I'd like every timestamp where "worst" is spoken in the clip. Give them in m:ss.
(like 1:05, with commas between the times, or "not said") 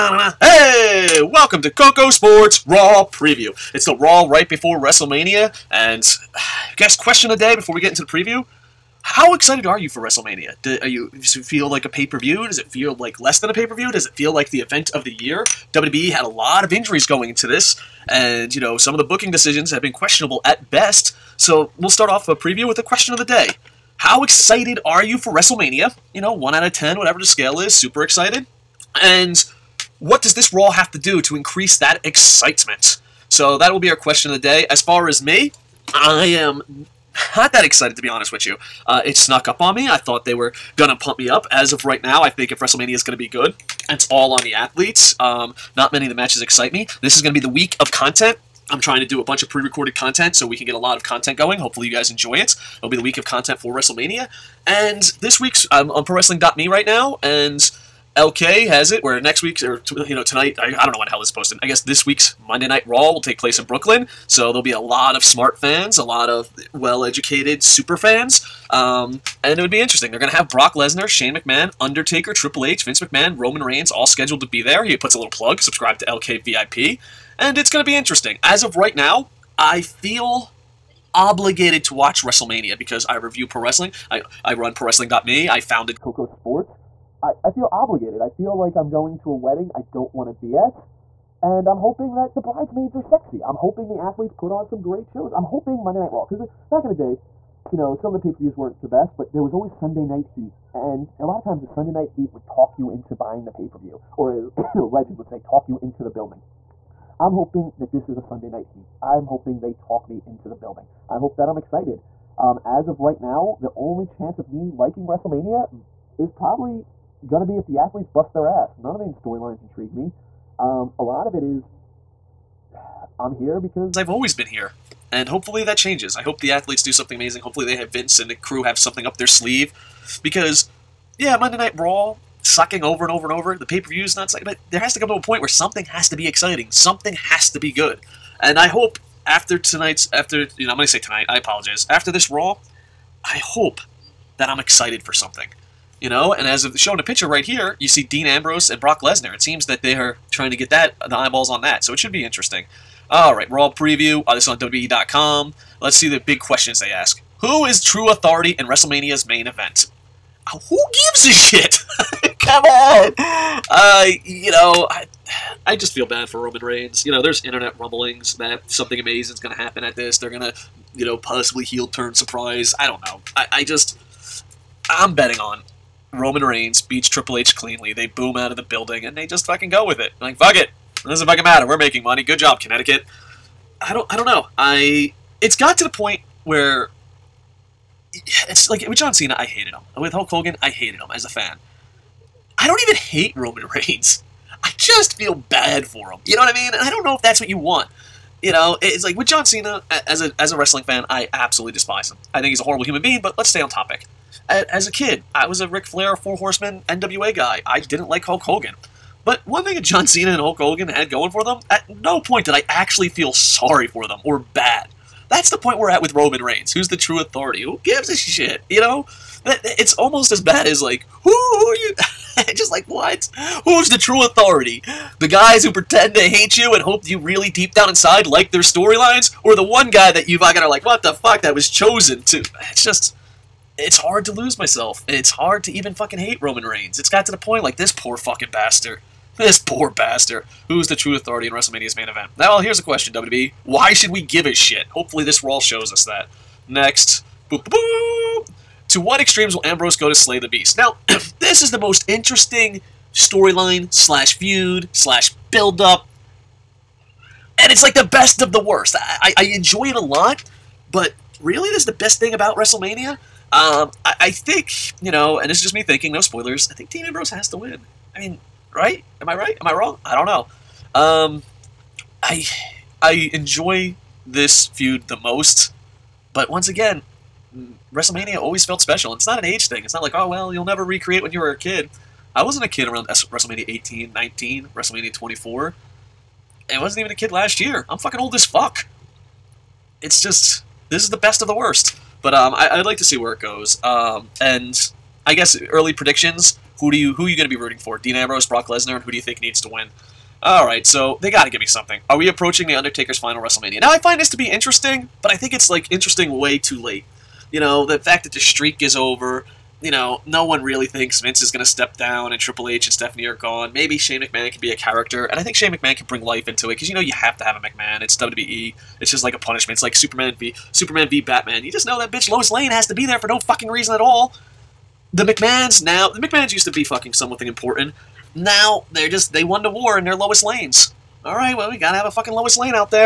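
4:18, 4:51.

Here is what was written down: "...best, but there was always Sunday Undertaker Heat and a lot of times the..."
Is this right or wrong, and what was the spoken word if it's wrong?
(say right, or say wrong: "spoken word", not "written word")
wrong: "Night", not "Undertaker".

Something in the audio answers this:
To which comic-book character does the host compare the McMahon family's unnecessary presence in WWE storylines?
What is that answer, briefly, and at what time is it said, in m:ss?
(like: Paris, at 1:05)
Lois Lane, at 5:22.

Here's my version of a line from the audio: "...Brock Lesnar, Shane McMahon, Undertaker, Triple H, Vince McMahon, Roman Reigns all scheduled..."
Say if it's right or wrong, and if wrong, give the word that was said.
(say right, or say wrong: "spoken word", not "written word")
right.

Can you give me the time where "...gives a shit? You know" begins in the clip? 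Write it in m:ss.
3:37.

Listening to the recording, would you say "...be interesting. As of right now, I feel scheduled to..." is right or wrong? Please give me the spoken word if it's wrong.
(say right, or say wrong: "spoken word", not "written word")
wrong: "obligated", not "scheduled".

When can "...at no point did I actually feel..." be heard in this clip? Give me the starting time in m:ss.
3:31.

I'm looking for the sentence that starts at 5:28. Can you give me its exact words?
Now they're just they won the war in their Lois Lanes.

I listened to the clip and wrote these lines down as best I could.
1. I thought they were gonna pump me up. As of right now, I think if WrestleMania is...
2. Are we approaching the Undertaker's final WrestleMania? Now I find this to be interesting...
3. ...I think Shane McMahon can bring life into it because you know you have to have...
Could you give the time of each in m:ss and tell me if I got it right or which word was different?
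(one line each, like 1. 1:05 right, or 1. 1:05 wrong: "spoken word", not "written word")
1. 0:39 right
2. 5:02 right
3. 5:15 right.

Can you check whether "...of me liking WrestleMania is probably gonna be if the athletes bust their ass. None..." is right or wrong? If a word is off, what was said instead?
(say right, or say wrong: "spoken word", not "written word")
right.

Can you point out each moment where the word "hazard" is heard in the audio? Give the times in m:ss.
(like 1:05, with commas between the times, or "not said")
not said.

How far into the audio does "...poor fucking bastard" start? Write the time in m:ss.
3:57.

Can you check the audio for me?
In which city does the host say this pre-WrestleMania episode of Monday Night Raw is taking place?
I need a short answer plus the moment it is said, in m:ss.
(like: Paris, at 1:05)
Brooklyn, at 1:03.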